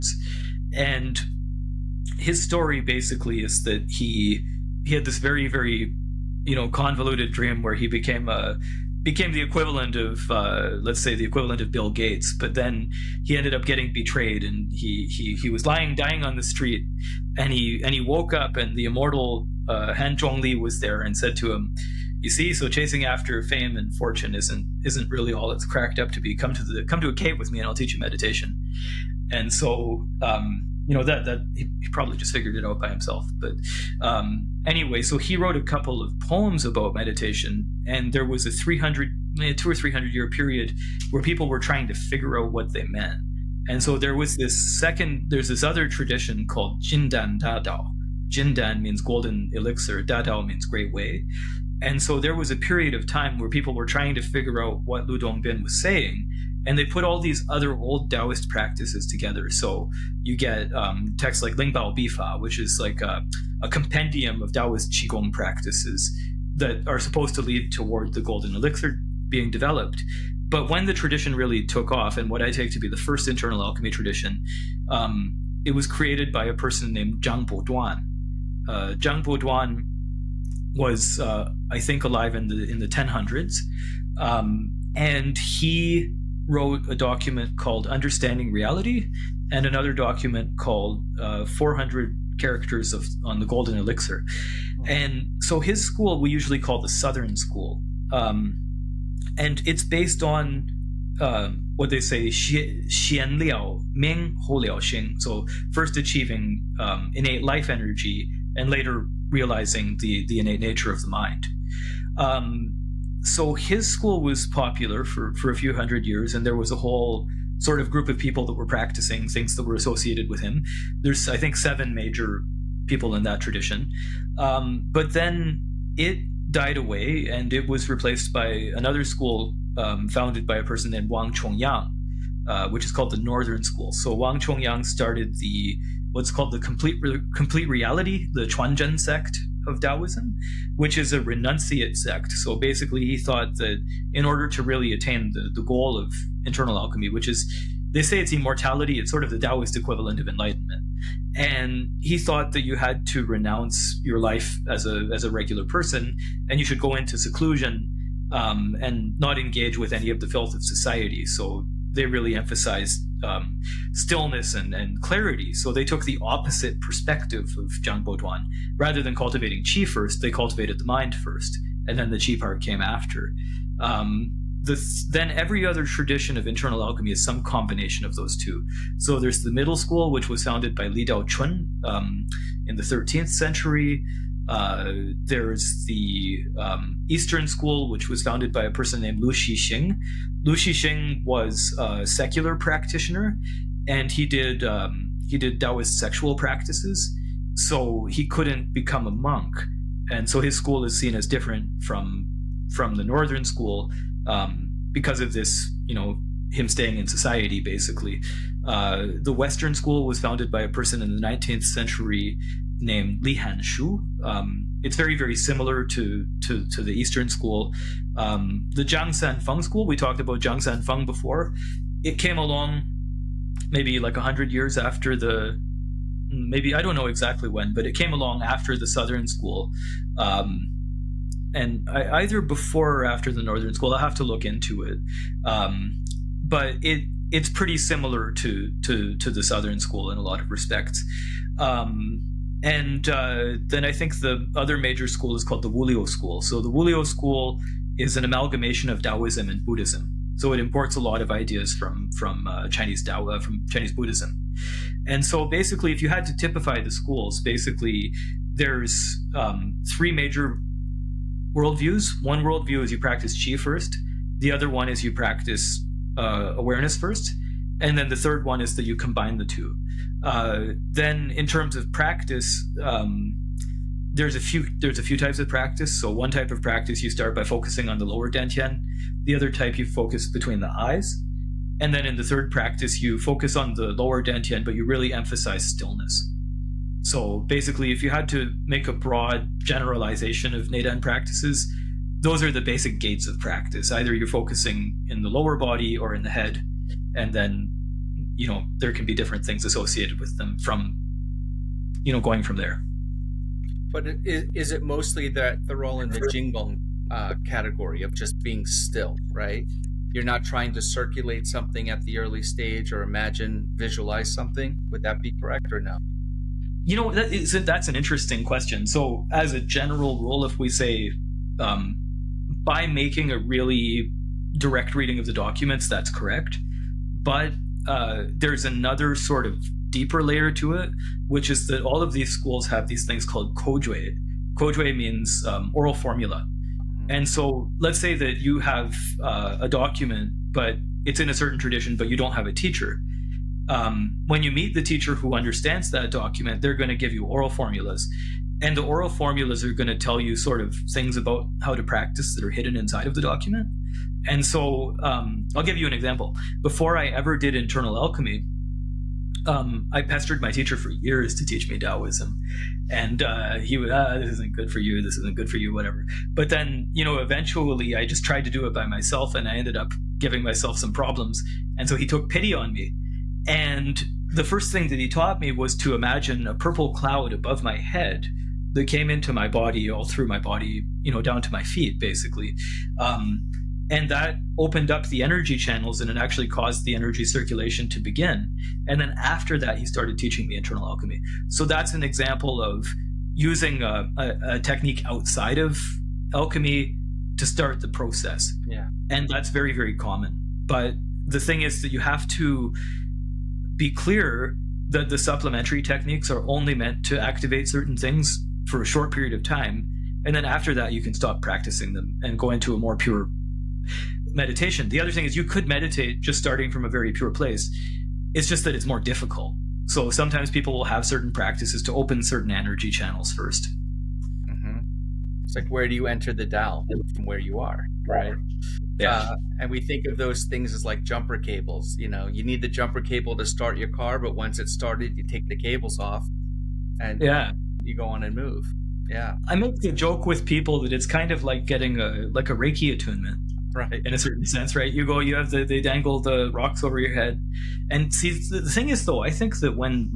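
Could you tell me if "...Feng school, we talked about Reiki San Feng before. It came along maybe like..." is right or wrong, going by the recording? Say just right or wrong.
wrong.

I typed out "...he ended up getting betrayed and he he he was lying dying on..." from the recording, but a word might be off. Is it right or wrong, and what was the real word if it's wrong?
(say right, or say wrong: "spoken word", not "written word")
right.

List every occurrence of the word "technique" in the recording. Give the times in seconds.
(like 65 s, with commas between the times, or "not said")
394 s, 405 s.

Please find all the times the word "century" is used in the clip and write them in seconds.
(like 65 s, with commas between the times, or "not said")
183 s, 211 s.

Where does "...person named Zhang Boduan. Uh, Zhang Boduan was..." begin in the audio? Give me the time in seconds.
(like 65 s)
76 s.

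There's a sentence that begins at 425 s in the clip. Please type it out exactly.
It's like where do you enter the Tao from where you are, right?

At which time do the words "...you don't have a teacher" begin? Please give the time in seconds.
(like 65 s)
342 s.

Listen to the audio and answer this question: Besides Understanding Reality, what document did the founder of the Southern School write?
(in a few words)
400 Characters on the Golden Elixir.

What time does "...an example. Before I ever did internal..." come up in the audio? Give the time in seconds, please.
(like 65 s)
355 s.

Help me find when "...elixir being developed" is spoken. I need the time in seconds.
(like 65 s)
68 s.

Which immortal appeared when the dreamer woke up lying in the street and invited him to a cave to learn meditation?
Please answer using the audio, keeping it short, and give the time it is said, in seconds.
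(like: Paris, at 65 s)
Han Zhongli, at 19 s.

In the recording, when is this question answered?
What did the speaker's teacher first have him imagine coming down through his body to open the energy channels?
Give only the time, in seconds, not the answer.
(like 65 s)
376 s.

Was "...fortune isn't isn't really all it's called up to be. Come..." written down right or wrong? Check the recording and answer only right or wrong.
wrong.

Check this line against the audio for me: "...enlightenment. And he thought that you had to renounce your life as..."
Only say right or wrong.
right.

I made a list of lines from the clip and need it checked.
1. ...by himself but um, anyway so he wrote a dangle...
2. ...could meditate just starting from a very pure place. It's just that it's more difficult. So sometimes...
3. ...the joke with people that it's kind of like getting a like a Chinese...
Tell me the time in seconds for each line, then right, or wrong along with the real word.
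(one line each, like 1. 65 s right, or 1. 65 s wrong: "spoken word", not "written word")
1. 32 s wrong: "couple", not "dangle"
2. 415 s right
3. 439 s wrong: "Reiki", not "Chinese".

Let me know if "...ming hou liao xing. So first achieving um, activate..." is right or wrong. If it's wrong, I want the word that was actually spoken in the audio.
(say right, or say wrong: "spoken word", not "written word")
wrong: "innate", not "activate".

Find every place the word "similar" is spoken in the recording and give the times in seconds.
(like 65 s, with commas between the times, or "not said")
215 s, 237 s.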